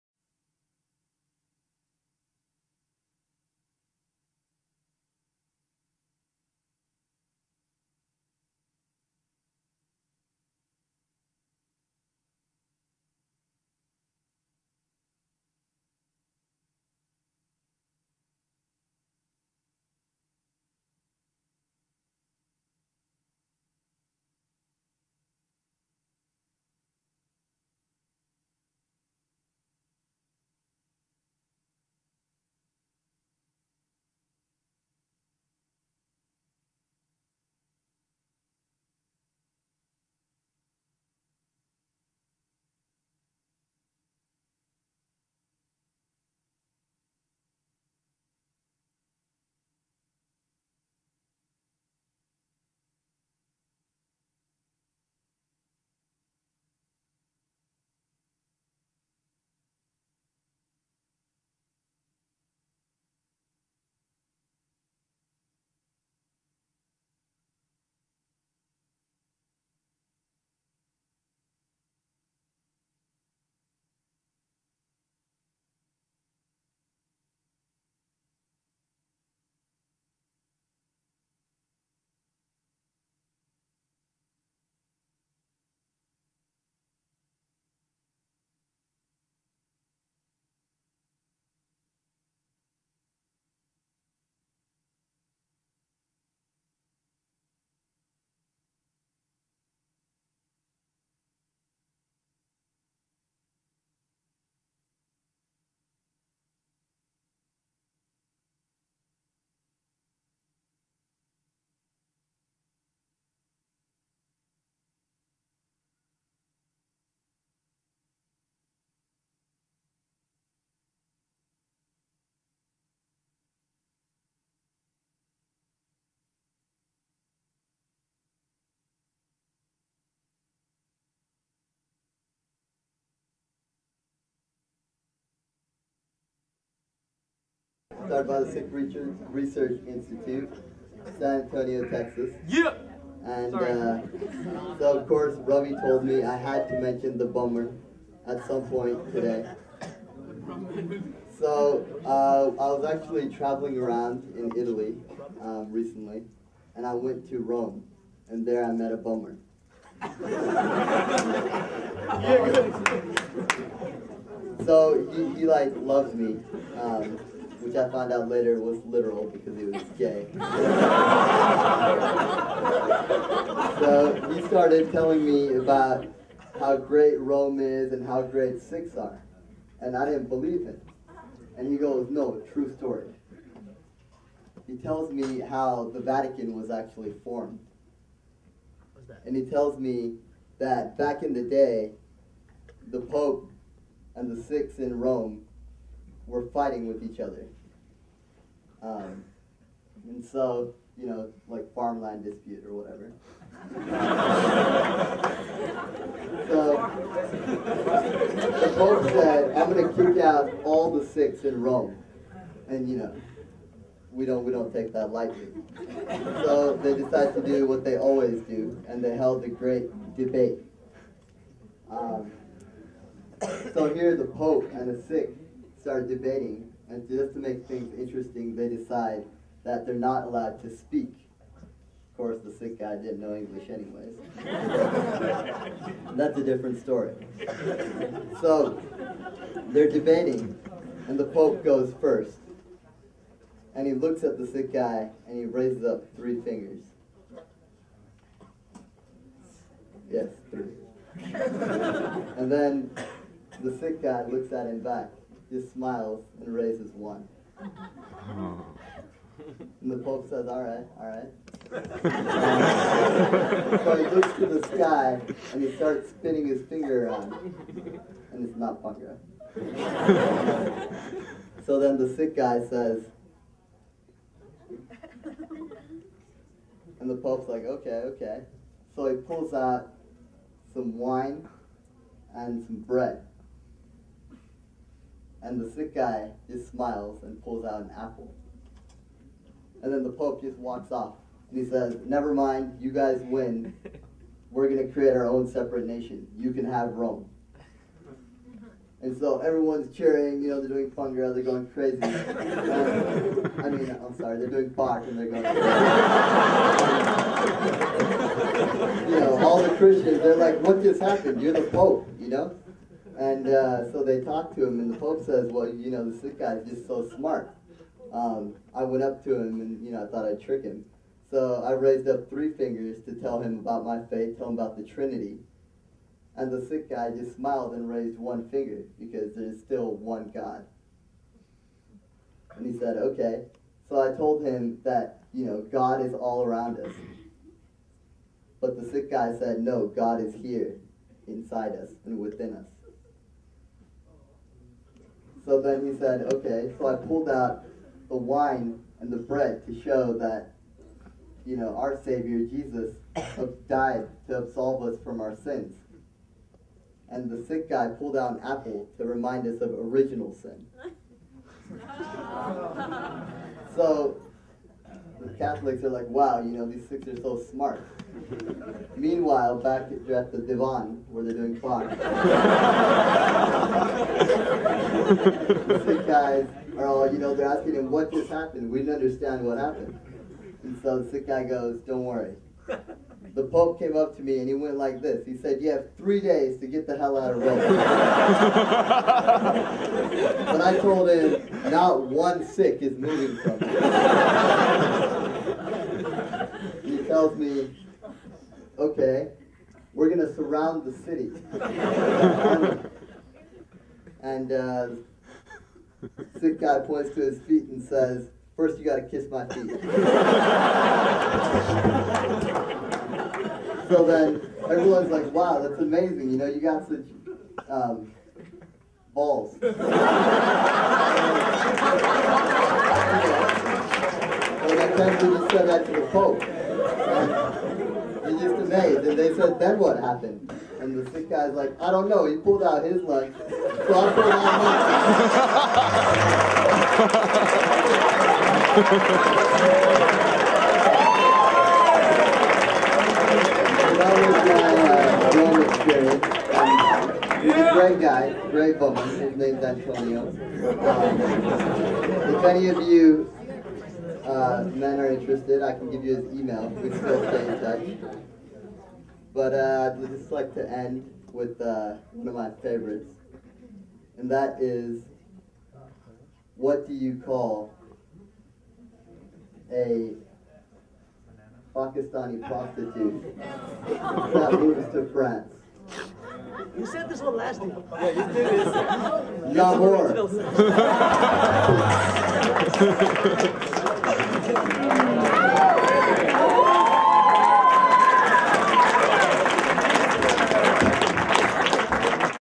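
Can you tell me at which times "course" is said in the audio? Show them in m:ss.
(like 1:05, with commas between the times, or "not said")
2:25, 3:52.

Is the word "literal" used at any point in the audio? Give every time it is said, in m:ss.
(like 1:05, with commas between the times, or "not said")
2:48.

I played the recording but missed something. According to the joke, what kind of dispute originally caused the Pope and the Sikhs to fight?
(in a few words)
Farmland dispute.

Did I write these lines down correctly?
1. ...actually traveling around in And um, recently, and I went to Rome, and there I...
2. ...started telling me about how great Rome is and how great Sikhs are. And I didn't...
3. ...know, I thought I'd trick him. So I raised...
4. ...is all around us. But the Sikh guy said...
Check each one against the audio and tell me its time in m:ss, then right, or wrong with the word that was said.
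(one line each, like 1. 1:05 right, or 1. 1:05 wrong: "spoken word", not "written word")
1. 2:32 wrong: "Italy", not "And"
2. 2:54 right
3. 5:19 right
4. 5:36 right.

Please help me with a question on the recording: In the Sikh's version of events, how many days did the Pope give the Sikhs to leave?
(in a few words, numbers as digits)
3 days.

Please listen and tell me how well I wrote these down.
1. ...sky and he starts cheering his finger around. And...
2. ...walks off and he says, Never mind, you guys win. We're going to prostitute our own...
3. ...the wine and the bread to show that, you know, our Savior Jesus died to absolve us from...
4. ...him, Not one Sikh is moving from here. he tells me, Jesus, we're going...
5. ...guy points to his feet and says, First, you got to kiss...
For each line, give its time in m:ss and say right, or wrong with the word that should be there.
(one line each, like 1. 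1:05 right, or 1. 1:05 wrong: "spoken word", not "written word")
1. 4:24 wrong: "spinning", not "cheering"
2. 4:50 wrong: "create", not "prostitute"
3. 5:48 right
4. 6:31 wrong: "Okay", not "Jesus"
5. 6:46 right.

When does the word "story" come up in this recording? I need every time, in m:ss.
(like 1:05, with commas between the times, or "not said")
3:02, 3:56.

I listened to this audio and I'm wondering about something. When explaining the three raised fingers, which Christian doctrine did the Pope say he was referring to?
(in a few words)
The Trinity.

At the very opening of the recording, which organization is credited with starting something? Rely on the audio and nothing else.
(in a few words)
Sikh Research Institute.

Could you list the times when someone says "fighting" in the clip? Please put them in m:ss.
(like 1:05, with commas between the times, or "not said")
3:16.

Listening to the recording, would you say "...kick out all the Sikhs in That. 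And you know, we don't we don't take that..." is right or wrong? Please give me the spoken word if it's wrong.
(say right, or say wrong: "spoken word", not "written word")
wrong: "Rome", not "That".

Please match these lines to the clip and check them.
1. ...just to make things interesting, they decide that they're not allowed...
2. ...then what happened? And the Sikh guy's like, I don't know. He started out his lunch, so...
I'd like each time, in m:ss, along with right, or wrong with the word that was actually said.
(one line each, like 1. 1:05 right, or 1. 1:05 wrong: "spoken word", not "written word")
1. 3:47 right
2. 7:09 wrong: "pulled", not "started".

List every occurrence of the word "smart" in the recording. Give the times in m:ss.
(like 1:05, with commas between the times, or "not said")
5:17, 6:07.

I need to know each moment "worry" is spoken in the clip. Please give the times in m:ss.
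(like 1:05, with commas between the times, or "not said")
6:22.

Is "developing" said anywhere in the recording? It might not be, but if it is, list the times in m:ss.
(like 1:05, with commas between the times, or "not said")
not said.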